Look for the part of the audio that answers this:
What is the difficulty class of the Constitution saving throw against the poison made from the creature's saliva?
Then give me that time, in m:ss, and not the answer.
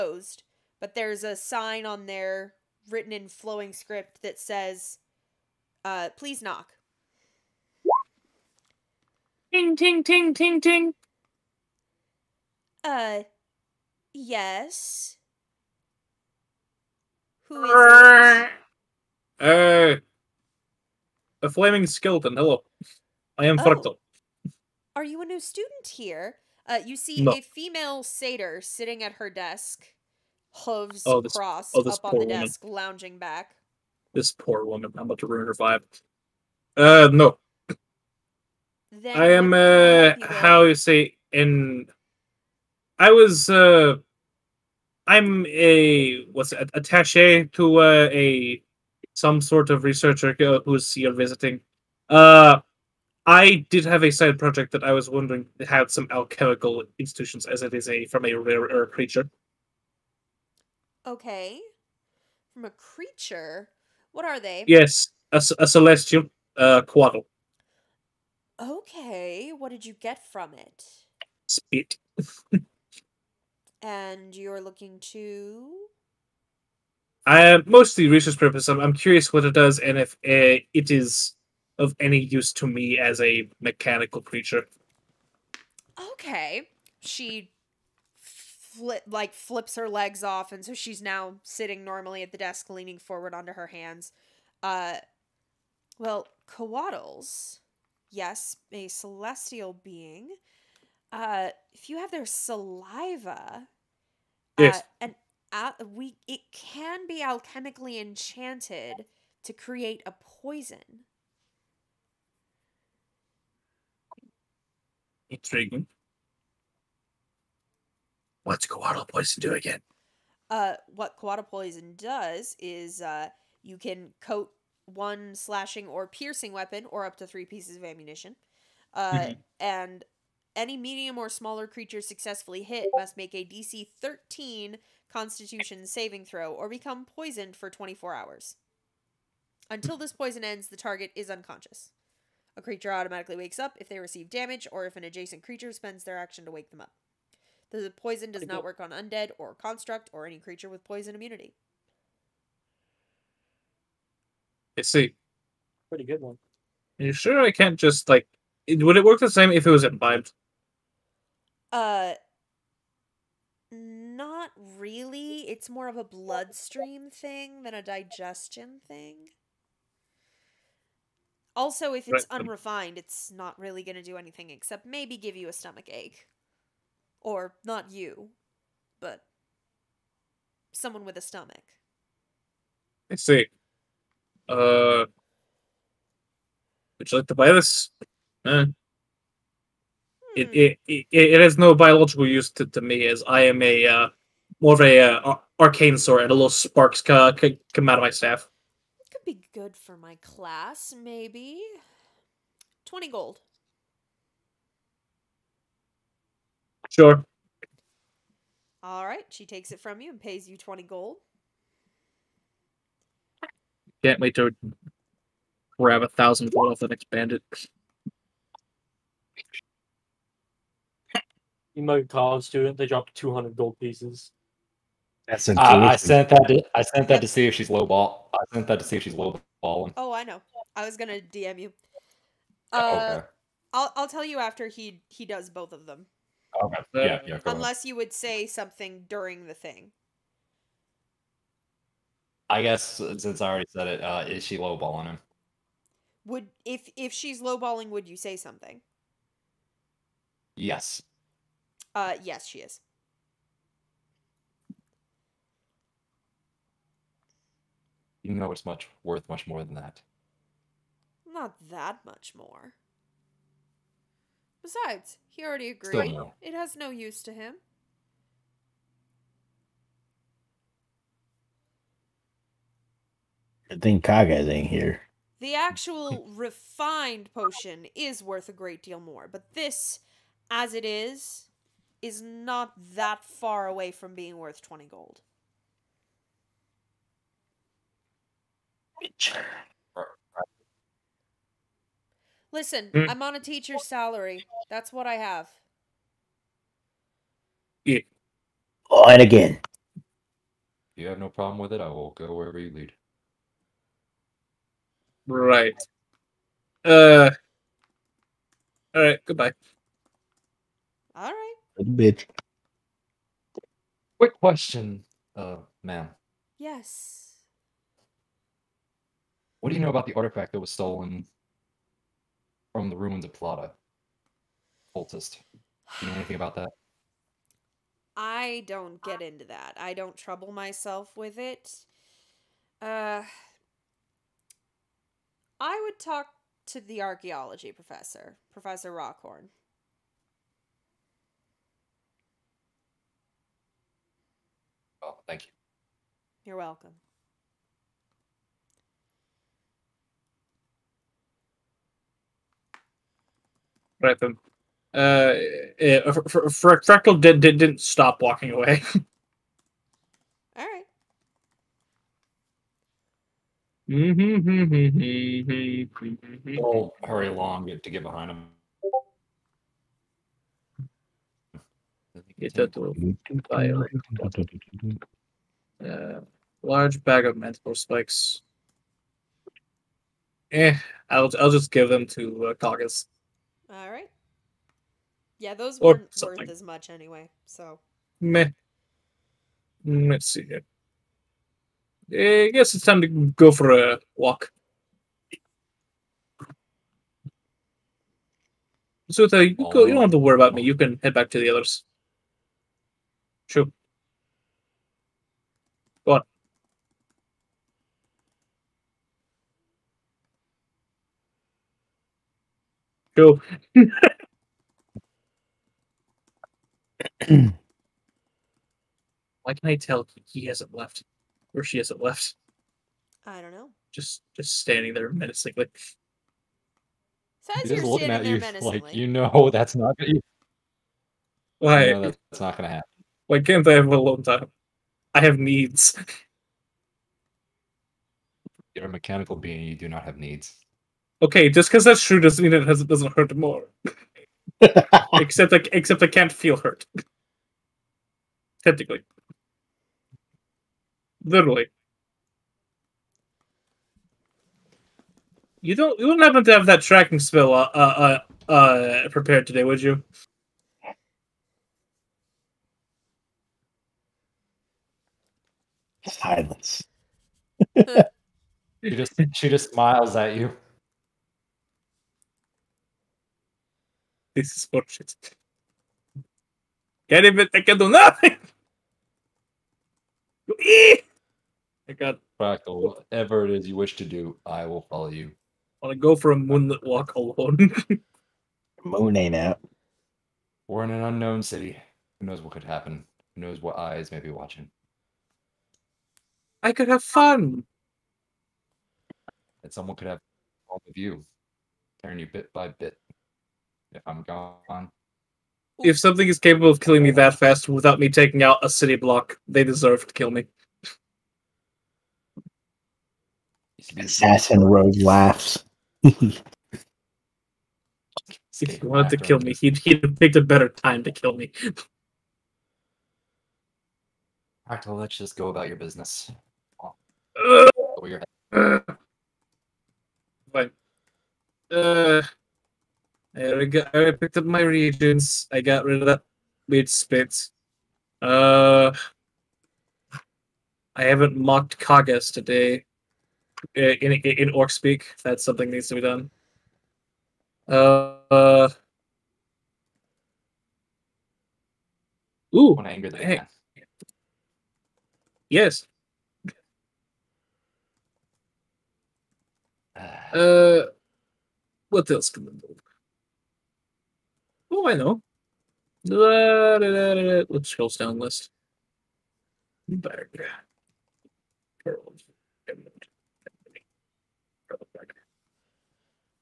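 2:13.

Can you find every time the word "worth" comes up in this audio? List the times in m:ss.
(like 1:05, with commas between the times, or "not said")
4:19, 4:38, 4:44, 6:26.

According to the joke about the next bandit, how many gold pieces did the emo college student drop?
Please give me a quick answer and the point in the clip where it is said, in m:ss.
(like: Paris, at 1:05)
200, at 3:43.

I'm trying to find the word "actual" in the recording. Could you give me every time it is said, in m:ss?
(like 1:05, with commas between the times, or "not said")
4:35.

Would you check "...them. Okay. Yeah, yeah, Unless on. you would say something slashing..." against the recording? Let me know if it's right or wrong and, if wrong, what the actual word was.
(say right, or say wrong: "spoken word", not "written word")
wrong: "during", not "slashing".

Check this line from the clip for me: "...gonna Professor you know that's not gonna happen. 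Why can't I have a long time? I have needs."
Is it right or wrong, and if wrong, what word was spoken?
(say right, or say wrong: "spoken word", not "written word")
wrong: "Why", not "Professor".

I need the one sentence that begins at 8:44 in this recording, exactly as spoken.
Alright, well, let's just go about your business.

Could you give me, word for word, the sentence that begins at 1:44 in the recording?
Uh, and uh, we it can be alchemically enchanted to create a poison.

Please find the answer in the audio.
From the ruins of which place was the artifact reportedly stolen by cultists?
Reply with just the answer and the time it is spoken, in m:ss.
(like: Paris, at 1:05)
Plata, at 5:23.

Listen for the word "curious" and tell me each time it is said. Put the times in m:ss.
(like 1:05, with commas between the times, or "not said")
1:18.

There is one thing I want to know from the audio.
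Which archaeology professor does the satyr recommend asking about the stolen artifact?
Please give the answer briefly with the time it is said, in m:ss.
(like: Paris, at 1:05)
Professor Rockhorn, at 5:38.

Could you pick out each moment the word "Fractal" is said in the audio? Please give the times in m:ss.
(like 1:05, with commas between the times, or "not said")
0:23, 5:56.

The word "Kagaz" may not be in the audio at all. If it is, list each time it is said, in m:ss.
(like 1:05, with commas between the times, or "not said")
4:34, 9:01.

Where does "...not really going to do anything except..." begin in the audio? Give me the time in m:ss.
2:53.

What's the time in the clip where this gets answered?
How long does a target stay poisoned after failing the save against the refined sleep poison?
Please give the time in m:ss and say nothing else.
2:17.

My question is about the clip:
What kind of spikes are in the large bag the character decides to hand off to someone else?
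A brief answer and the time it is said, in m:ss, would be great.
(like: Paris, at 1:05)
manticore spikes, at 6:17.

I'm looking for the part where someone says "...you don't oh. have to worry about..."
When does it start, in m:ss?
6:39.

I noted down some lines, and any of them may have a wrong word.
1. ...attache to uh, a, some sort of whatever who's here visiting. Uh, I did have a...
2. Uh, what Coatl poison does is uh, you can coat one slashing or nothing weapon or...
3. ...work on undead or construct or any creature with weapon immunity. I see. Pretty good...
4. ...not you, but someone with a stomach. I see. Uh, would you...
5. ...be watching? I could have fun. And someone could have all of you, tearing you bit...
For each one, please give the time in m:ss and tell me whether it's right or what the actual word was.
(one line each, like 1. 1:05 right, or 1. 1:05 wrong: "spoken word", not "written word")
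1. 0:46 wrong: "researcher", not "whatever"
2. 2:00 wrong: "piercing", not "nothing"
3. 2:28 wrong: "poison", not "weapon"
4. 2:57 right
5. 8:14 right.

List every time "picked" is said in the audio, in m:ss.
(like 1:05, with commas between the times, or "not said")
8:40, 8:54.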